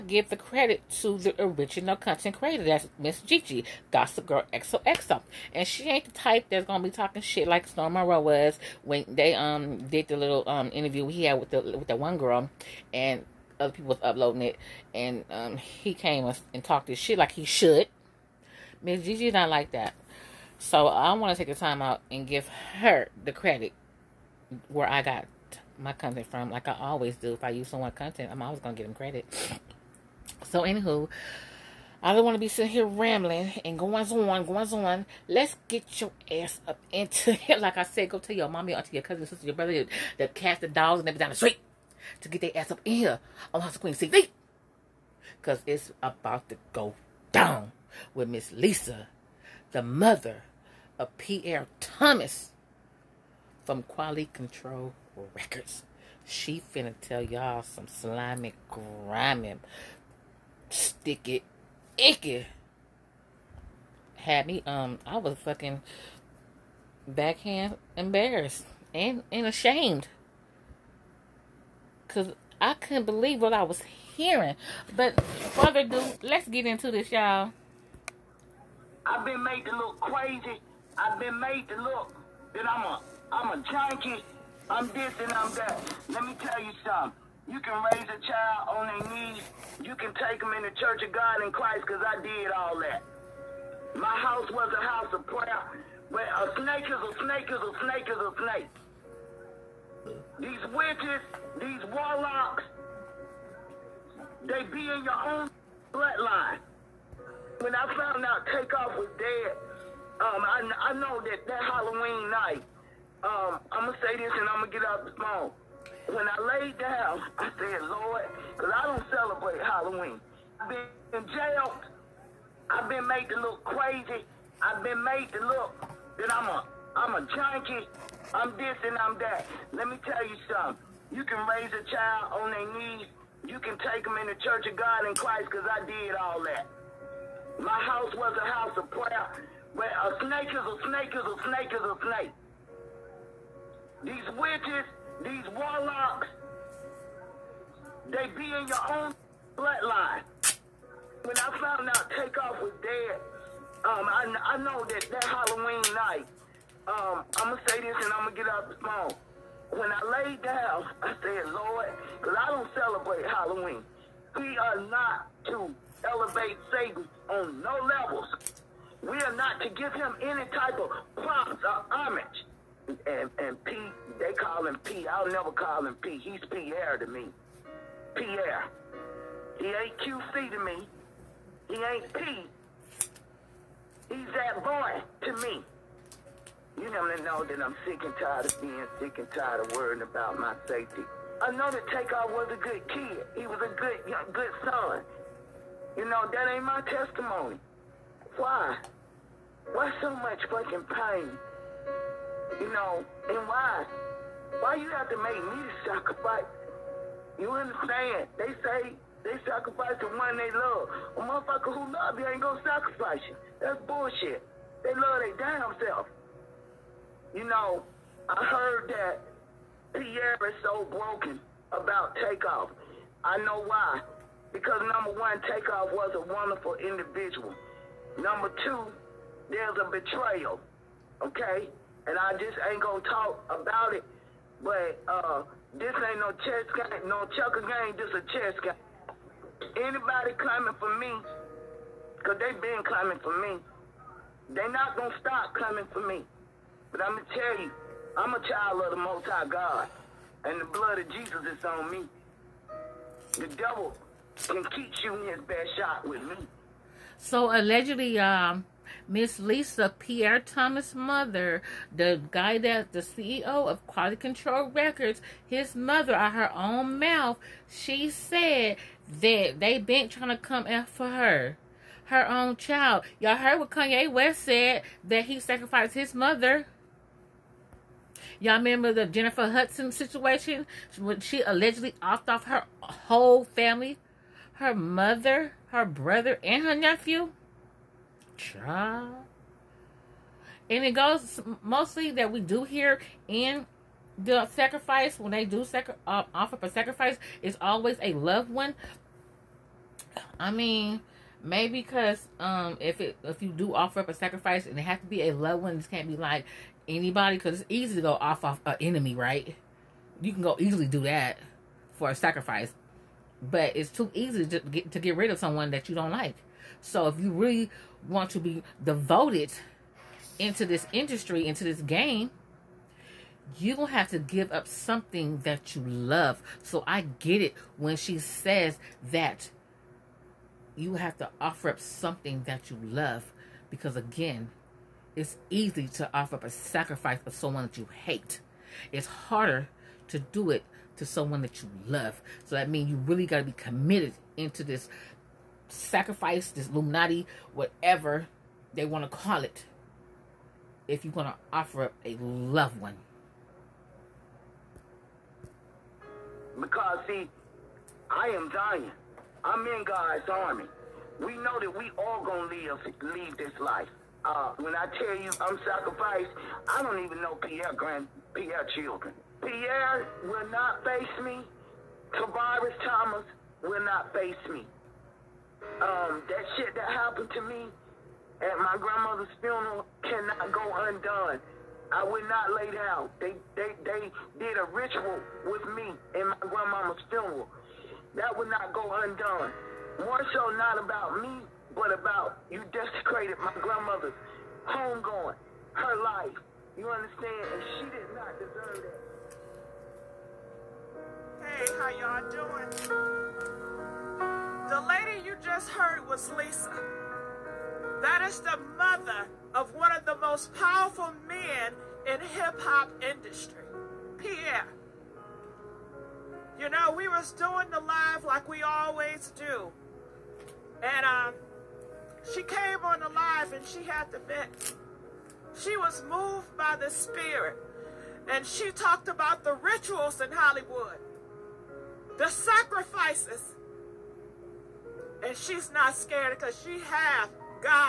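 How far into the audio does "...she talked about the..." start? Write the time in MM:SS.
07:08.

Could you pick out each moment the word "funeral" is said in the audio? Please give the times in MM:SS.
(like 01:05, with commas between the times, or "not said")
06:19, 06:27.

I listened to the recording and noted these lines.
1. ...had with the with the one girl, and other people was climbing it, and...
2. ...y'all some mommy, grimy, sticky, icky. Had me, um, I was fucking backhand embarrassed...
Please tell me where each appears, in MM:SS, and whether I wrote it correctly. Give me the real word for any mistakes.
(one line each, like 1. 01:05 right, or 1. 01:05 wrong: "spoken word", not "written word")
1. 00:11 wrong: "uploading", not "climbing"
2. 00:57 wrong: "slimy", not "mommy".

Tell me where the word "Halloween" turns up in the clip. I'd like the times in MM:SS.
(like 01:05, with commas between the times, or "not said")
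01:51, 01:59, 02:35, 02:43.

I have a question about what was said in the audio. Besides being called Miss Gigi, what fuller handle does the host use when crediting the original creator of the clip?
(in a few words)
Gossip Girl XOXO.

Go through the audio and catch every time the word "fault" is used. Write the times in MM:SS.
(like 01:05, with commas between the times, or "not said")
not said.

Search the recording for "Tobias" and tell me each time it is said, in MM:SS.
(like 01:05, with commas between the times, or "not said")
06:12.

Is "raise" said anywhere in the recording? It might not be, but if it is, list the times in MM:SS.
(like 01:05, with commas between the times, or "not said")
01:27, 02:11.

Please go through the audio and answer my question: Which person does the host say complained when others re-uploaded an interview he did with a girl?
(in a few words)
Storm Monroe.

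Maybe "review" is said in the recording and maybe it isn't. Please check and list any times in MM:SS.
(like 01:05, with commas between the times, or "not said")
not said.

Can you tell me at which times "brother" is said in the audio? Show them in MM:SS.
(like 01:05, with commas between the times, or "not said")
00:39, 04:45.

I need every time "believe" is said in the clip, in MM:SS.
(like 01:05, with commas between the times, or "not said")
01:13.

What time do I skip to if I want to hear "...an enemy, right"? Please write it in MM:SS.
05:08.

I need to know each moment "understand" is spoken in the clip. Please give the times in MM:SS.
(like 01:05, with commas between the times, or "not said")
03:27, 06:36.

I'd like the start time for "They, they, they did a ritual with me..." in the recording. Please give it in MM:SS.
06:23.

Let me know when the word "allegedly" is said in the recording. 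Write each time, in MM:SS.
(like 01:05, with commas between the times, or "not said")
04:17, 04:41.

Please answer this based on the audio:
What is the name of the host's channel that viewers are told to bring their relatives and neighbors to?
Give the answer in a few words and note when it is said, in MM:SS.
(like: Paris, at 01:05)
House of Queen TV, at 00:43.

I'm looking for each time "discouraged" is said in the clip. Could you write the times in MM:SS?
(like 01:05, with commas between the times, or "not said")
not said.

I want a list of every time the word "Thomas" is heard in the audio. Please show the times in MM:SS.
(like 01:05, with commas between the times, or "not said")
00:51, 04:20, 06:12.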